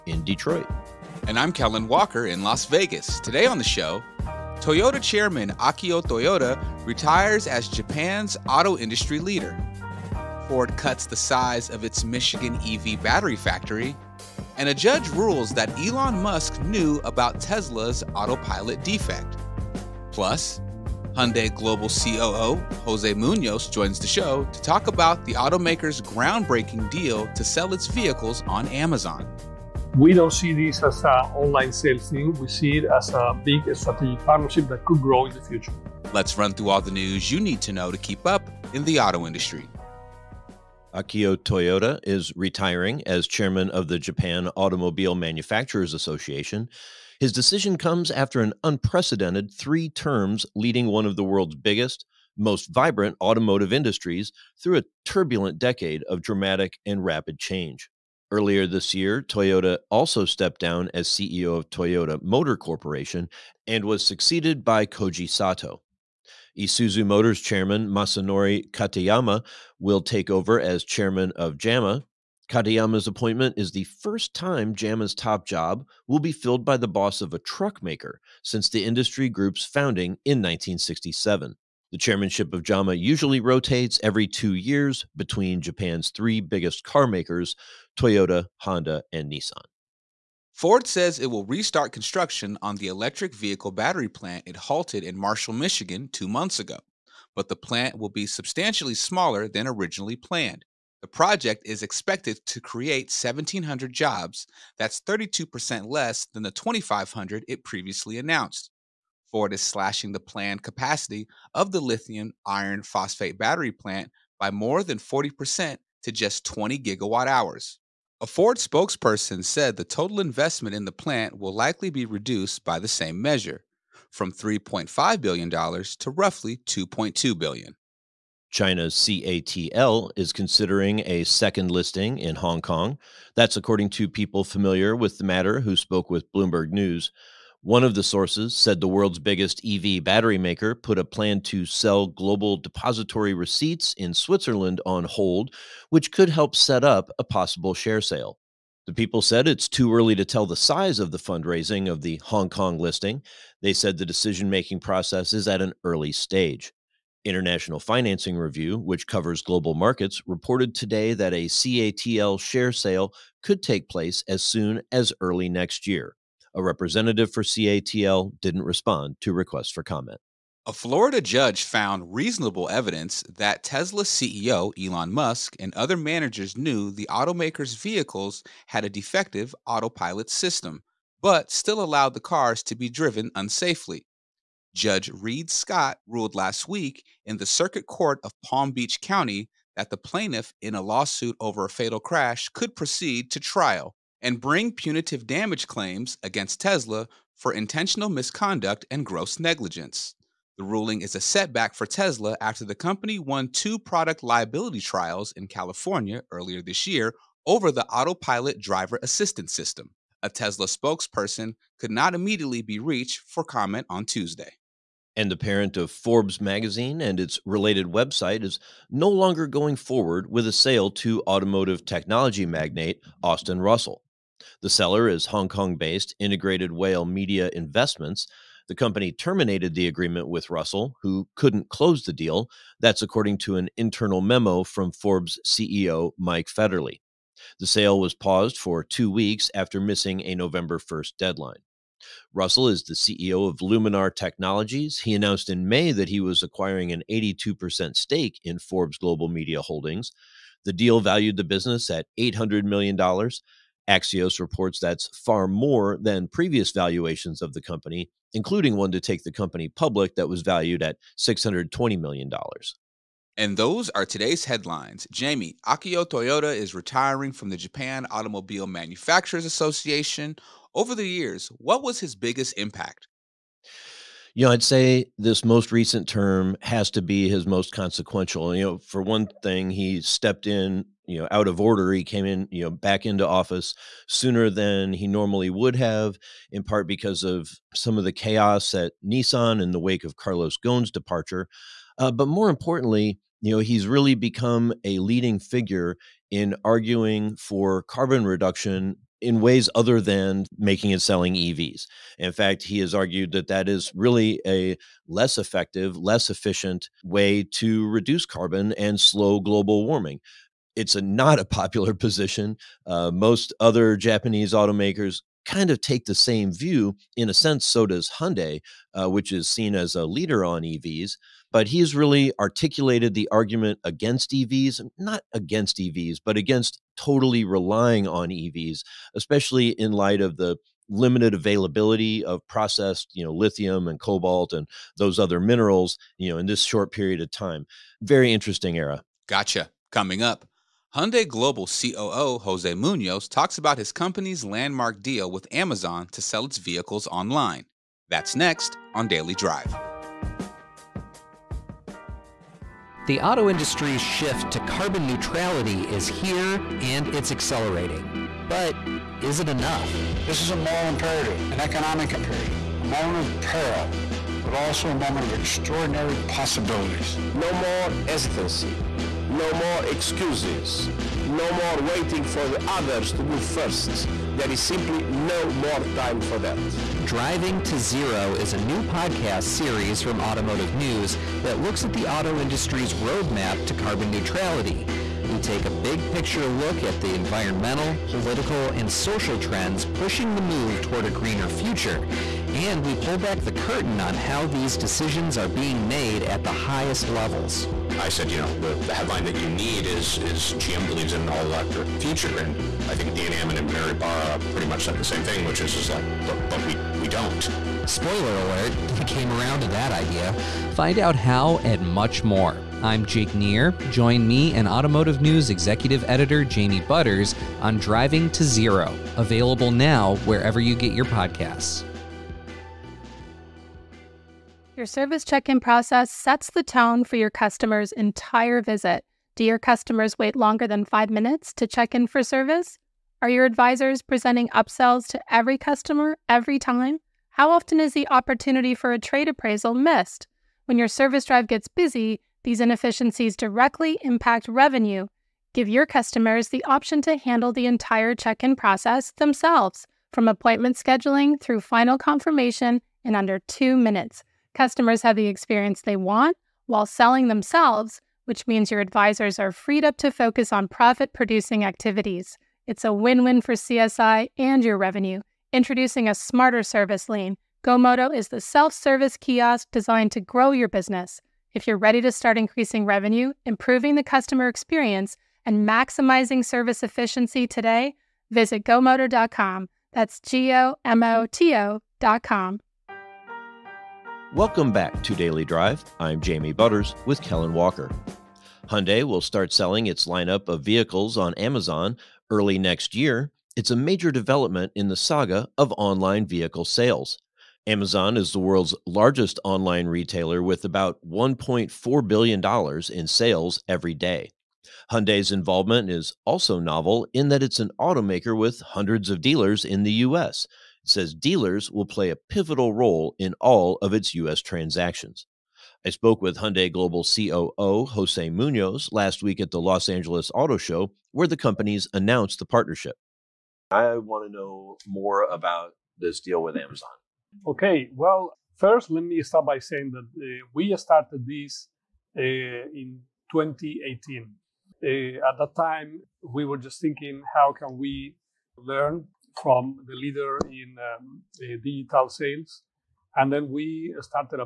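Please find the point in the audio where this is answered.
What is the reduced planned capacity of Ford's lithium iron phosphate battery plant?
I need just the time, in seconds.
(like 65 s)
116 s.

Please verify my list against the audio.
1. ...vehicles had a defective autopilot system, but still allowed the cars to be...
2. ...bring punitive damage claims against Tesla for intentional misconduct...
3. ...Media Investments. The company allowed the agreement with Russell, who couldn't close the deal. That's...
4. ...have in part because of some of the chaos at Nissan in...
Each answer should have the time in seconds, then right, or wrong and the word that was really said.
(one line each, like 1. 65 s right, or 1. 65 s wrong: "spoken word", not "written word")
1. 177 s right
2. 194 s right
3. 227 s wrong: "terminated", not "allowed"
4. 285 s right.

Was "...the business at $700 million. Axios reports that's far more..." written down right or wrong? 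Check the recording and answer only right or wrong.
wrong.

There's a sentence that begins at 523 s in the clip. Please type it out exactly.
I want to know more about this deal with Amazon.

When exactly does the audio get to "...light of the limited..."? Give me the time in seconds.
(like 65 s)
329 s.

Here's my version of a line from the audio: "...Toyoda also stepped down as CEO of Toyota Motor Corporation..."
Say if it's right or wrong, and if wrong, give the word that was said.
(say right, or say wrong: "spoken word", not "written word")
right.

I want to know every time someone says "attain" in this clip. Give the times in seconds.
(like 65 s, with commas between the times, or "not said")
not said.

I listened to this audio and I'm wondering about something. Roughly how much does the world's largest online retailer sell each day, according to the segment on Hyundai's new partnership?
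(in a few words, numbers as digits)
$1.4 billion.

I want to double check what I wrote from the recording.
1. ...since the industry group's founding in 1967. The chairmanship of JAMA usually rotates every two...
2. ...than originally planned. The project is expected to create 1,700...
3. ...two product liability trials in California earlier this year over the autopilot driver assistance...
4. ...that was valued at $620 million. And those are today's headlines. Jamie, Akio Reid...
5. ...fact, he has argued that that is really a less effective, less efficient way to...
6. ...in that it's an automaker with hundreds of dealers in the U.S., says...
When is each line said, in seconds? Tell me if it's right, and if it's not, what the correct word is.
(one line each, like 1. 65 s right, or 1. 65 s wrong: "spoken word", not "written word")
1. 78 s right
2. 99 s right
3. 203 s right
4. 260 s wrong: "Toyoda", not "Reid"
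5. 302 s right
6. 507 s right.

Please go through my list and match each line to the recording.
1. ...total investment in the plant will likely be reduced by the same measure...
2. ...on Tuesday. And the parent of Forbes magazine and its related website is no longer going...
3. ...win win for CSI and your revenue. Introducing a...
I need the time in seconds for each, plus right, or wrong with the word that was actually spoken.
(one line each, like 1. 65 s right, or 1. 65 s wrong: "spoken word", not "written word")
1. 119 s right
2. 213 s right
3. 462 s right.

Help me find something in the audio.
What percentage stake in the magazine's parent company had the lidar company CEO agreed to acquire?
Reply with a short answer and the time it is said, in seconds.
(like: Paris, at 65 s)
82%, at 247 s.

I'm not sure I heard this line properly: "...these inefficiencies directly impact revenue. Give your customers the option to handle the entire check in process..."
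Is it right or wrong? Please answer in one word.
right.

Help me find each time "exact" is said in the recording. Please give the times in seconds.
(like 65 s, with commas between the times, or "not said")
not said.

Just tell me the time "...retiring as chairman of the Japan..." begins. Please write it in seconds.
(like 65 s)
42 s.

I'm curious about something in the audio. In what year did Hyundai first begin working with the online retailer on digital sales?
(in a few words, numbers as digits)
2018.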